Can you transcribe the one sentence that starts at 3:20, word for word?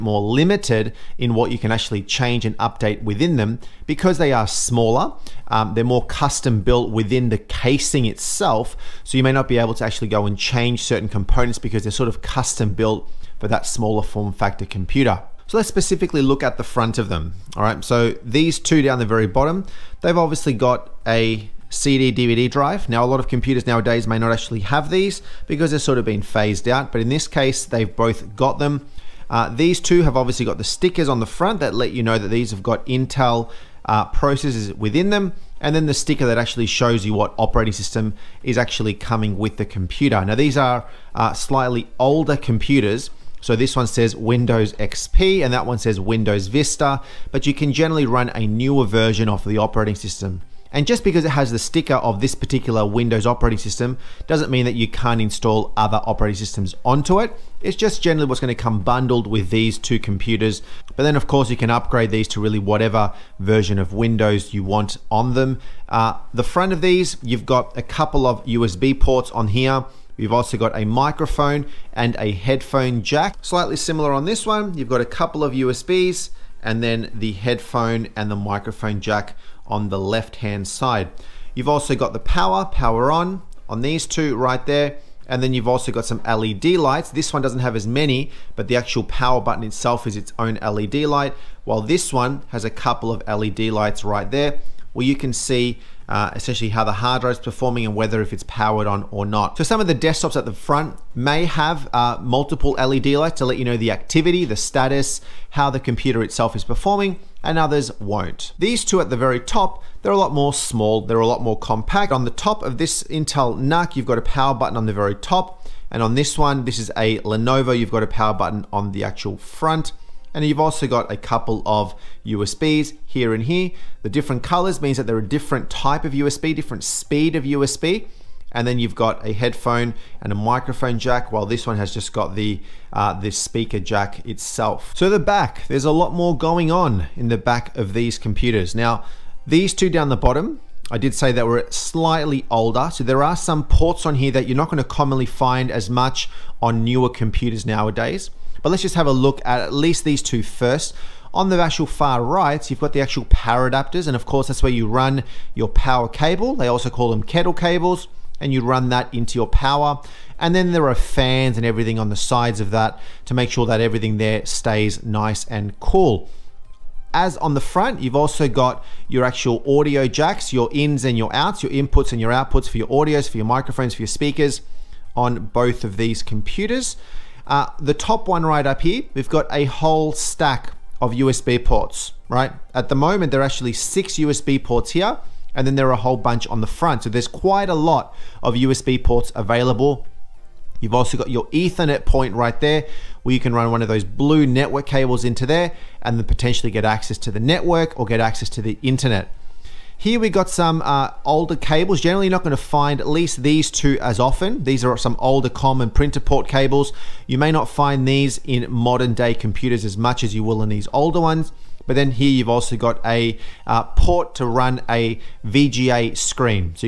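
Here we got some uh, older cables.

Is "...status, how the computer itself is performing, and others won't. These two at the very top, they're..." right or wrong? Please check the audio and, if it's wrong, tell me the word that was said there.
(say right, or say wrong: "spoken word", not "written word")
right.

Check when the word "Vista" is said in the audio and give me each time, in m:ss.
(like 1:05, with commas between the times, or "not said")
0:46.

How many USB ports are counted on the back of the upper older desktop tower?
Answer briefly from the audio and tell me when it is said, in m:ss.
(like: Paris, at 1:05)
6, at 3:03.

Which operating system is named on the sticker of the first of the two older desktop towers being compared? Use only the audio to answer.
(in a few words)
Windows XP.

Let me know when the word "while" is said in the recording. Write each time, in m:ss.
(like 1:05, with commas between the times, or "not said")
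1:31, 2:11.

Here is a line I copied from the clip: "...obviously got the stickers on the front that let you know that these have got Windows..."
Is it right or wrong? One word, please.
wrong.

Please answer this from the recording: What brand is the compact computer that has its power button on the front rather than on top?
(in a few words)
Lenovo.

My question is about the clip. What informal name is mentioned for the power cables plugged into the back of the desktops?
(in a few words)
kettle cables.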